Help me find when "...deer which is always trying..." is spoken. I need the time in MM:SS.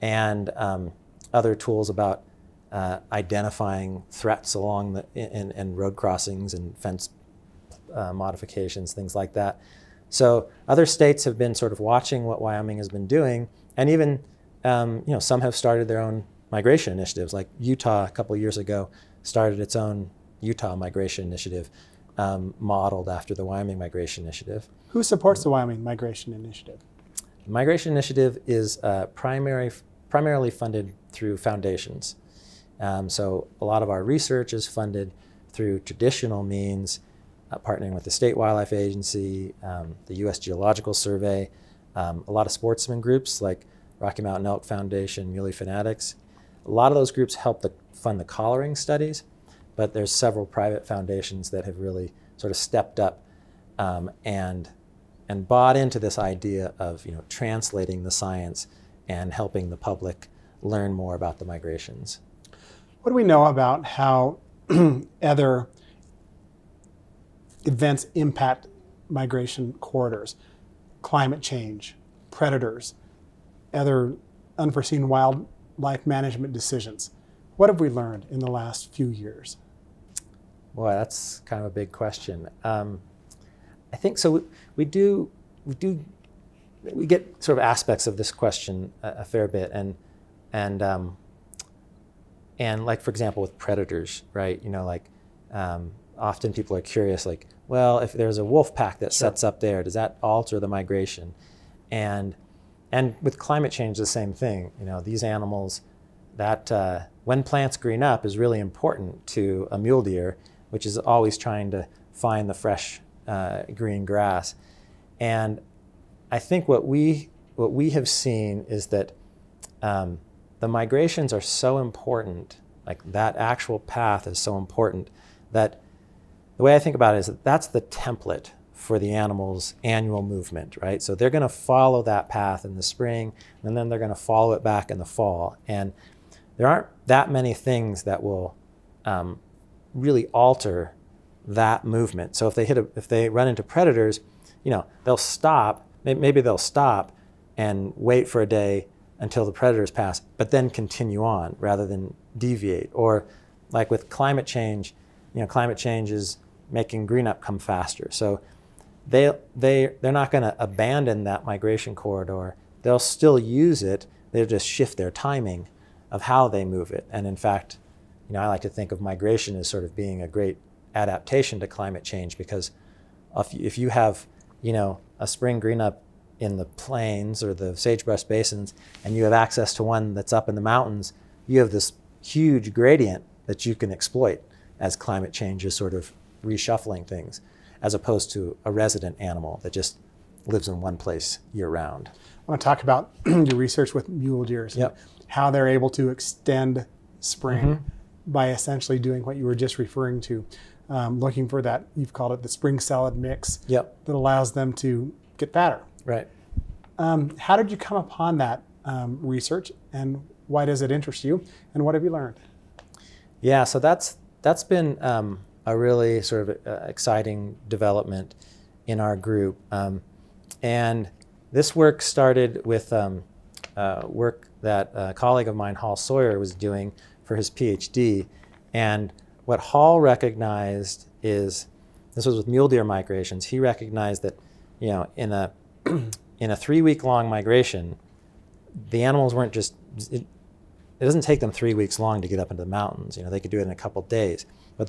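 01:50.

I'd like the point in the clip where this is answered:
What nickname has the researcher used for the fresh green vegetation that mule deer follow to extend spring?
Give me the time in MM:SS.
03:22.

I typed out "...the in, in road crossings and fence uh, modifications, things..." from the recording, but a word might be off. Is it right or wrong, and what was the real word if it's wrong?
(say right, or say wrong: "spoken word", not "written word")
right.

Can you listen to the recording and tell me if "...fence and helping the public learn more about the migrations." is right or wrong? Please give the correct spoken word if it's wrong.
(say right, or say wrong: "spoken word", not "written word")
wrong: "science", not "fence".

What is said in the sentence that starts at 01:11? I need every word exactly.
Climate change, predators, other unforeseen wildlife management decisions.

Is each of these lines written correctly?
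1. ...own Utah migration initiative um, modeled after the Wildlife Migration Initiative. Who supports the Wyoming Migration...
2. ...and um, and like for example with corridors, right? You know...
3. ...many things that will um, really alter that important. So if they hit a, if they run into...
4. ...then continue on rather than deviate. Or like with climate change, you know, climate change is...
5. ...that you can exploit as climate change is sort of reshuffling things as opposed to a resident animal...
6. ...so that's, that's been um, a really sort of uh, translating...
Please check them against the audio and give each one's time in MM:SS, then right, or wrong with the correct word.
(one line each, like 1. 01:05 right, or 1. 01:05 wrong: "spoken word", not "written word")
1. 00:19 wrong: "Wyoming", not "Wildlife"
2. 01:30 wrong: "predators", not "corridors"
3. 02:17 wrong: "movement", not "important"
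4. 02:30 right
5. 03:03 right
6. 03:33 wrong: "exciting", not "translating".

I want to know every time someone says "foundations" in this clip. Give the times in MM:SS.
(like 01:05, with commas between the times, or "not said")
00:31, 00:44, 00:50.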